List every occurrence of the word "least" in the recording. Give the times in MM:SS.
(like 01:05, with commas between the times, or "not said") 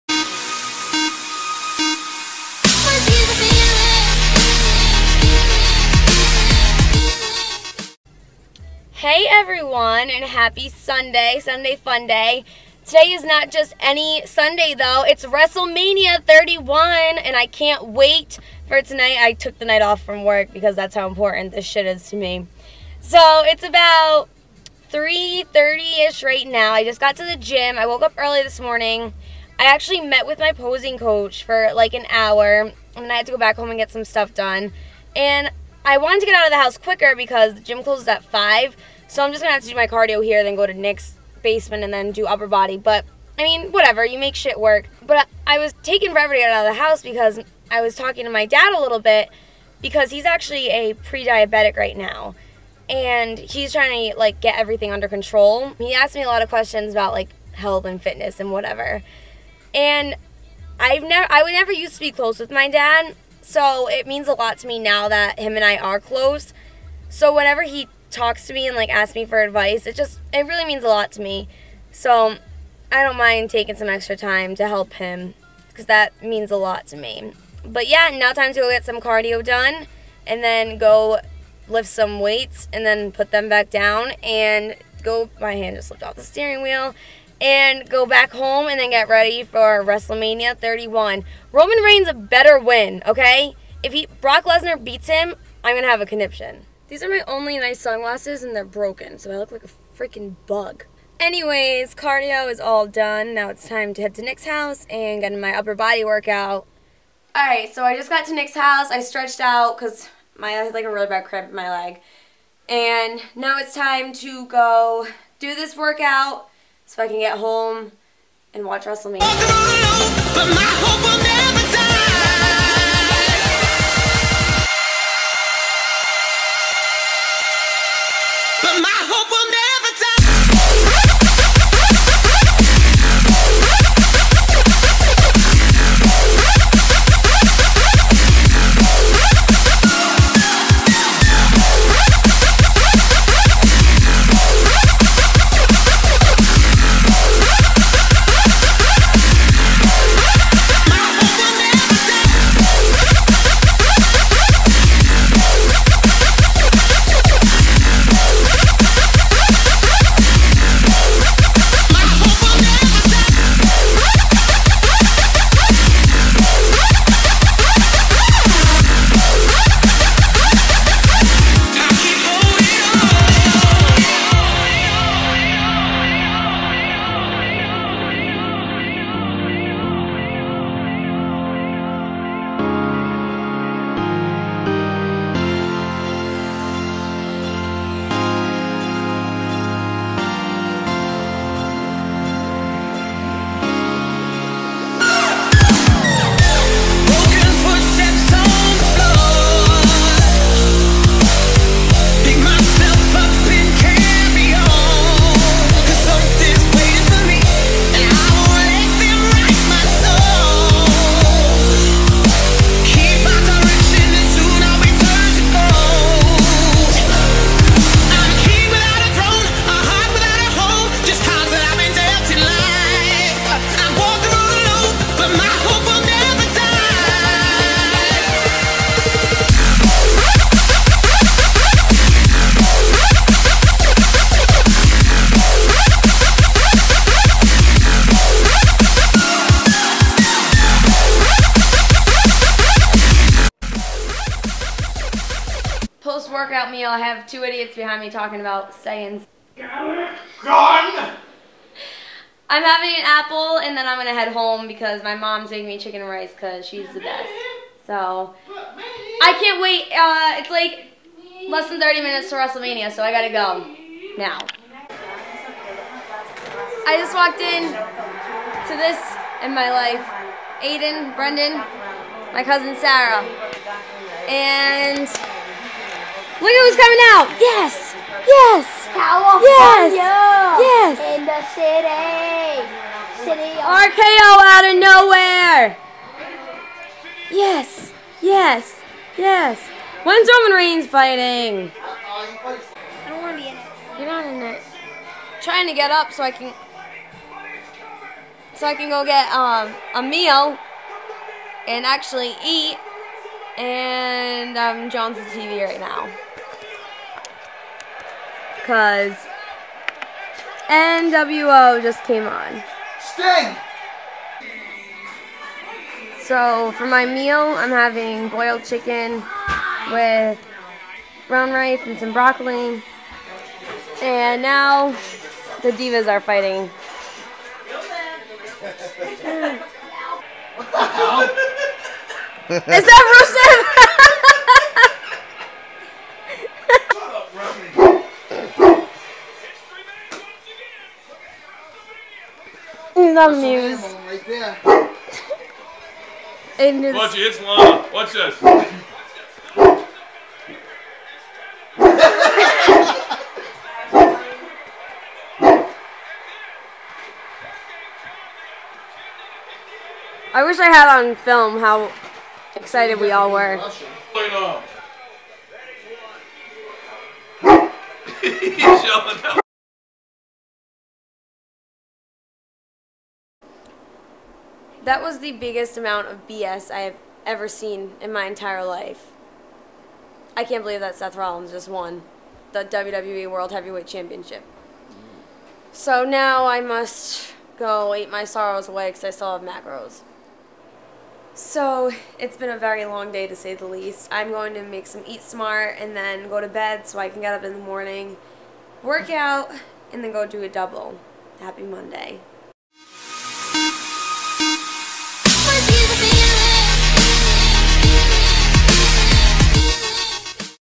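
06:33.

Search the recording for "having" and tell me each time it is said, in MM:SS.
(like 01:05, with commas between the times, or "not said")
04:12, 05:17.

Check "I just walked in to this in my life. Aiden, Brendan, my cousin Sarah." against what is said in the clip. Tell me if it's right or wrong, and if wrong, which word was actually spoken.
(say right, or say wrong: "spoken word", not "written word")
right.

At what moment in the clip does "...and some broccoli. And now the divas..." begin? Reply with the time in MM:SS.
05:21.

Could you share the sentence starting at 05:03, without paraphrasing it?
And I'm um, John's on TV right now because NWO just came on.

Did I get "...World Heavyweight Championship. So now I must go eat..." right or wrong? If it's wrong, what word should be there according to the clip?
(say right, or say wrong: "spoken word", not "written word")
right.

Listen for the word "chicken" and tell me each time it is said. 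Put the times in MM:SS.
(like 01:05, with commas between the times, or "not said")
04:15, 05:18.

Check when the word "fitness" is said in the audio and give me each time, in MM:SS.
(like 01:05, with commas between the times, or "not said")
00:58.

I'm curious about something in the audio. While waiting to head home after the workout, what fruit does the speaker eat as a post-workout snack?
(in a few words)
An apple.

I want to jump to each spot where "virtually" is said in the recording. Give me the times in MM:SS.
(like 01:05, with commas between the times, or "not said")
not said.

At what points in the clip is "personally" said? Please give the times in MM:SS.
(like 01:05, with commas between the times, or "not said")
not said.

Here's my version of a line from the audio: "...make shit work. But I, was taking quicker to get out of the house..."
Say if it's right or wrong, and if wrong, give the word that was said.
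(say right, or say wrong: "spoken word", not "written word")
wrong: "forever", not "quicker".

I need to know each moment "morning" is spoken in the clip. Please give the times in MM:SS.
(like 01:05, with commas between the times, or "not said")
00:28, 06:37.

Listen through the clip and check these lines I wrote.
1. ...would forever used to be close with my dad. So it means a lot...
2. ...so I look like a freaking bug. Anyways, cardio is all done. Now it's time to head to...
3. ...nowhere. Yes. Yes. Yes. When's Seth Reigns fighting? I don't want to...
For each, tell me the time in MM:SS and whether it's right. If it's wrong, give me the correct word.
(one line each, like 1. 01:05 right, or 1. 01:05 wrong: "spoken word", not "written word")
1. 01:01 wrong: "never", not "forever"
2. 01:39 right
3. 04:44 wrong: "Roman", not "Seth".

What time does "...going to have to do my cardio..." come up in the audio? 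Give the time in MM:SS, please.
00:39.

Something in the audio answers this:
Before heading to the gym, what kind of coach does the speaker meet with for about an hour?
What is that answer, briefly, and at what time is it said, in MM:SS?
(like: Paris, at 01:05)
Posing coach, at 00:30.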